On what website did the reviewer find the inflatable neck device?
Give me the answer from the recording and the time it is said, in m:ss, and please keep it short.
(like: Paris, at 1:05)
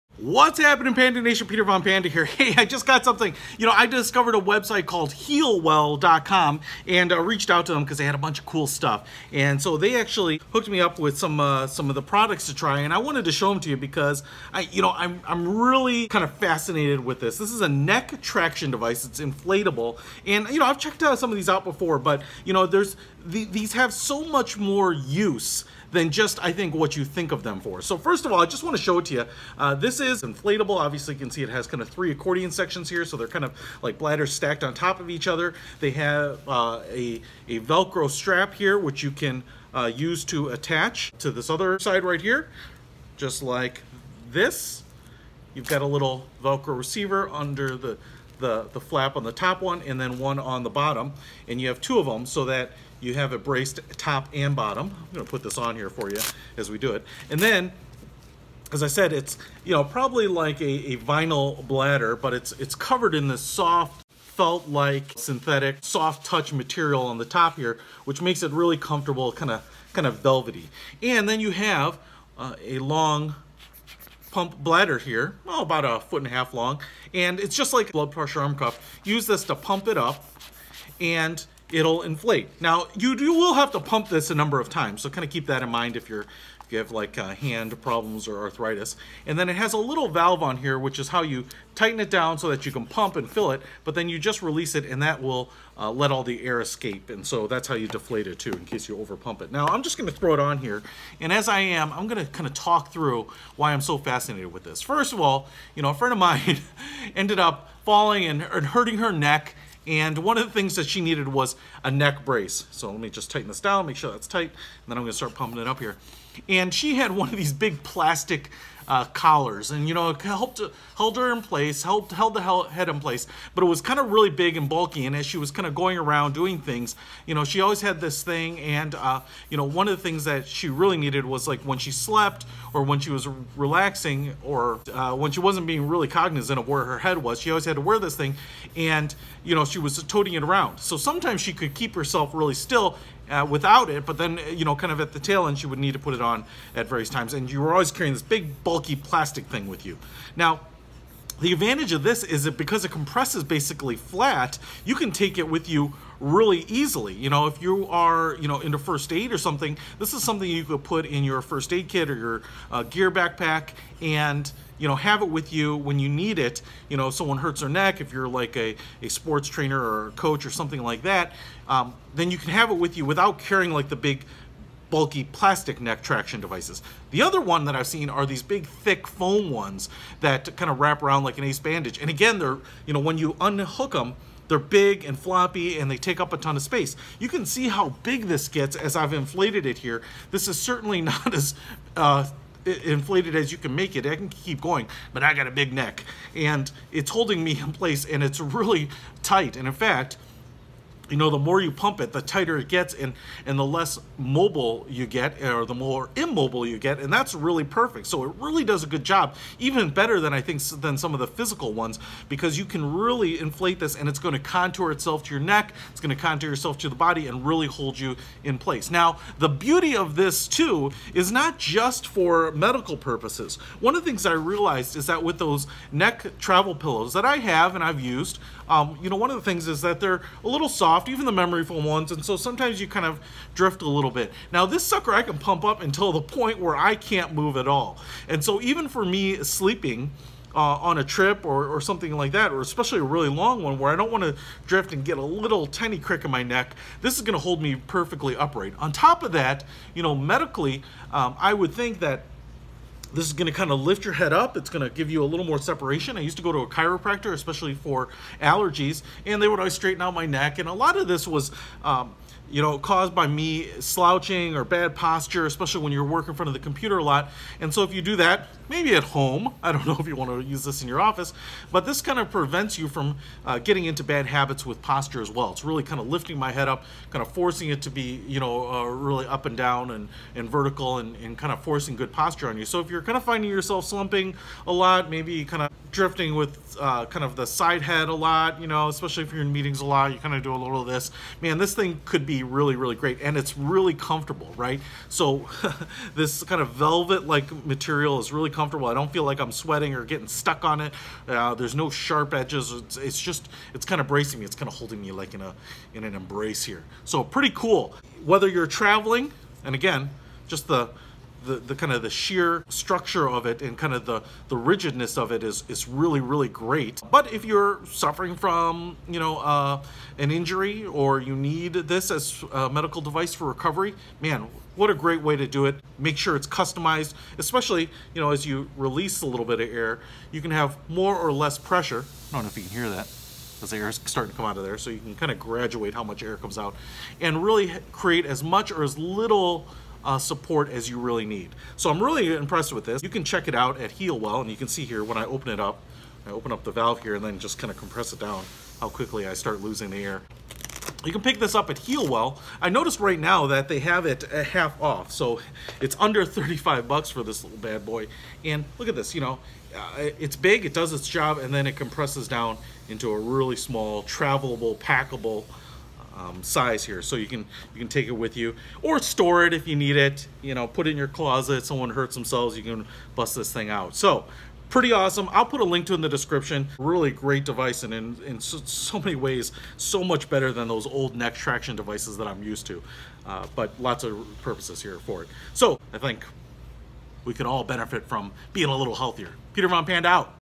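healwell.com, at 0:05.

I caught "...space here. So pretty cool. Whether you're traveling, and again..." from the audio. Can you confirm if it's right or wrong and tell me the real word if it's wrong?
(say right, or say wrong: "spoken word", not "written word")
wrong: "embrace", not "space".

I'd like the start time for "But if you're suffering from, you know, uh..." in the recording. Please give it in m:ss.
5:17.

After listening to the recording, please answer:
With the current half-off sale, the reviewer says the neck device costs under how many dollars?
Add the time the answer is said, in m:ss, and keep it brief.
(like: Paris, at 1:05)
35, at 5:56.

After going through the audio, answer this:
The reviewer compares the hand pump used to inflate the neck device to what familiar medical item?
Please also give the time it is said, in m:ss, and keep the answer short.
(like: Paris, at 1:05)
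blood pressure arm cuff, at 1:17.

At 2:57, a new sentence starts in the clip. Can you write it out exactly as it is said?
The other one that I've seen are these big thick foam ones that kind of wrap around like an ace bandage.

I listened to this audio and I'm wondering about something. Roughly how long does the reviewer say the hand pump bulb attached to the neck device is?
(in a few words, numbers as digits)
a foot and a half.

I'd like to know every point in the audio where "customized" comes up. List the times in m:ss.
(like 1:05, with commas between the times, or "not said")
5:26.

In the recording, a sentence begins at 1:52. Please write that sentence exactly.
So let me just tighten this down, make sure that's tight, and then I'm gonna start pumping it up here.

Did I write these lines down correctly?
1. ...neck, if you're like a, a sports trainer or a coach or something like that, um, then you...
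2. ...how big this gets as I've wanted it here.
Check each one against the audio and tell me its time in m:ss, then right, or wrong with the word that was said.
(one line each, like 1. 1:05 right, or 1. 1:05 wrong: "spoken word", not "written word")
1. 2:47 right
2. 3:07 wrong: "inflated", not "wanted".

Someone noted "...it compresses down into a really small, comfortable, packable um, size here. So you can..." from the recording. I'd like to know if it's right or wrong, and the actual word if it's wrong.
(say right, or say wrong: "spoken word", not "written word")
wrong: "travelable", not "comfortable".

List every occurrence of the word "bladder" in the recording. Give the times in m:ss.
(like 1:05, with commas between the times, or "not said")
0:33, 1:01, 1:14.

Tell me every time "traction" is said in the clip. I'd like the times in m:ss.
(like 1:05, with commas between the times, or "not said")
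0:18, 2:56, 6:21.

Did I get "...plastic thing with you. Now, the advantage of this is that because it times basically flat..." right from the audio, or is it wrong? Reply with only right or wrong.
wrong.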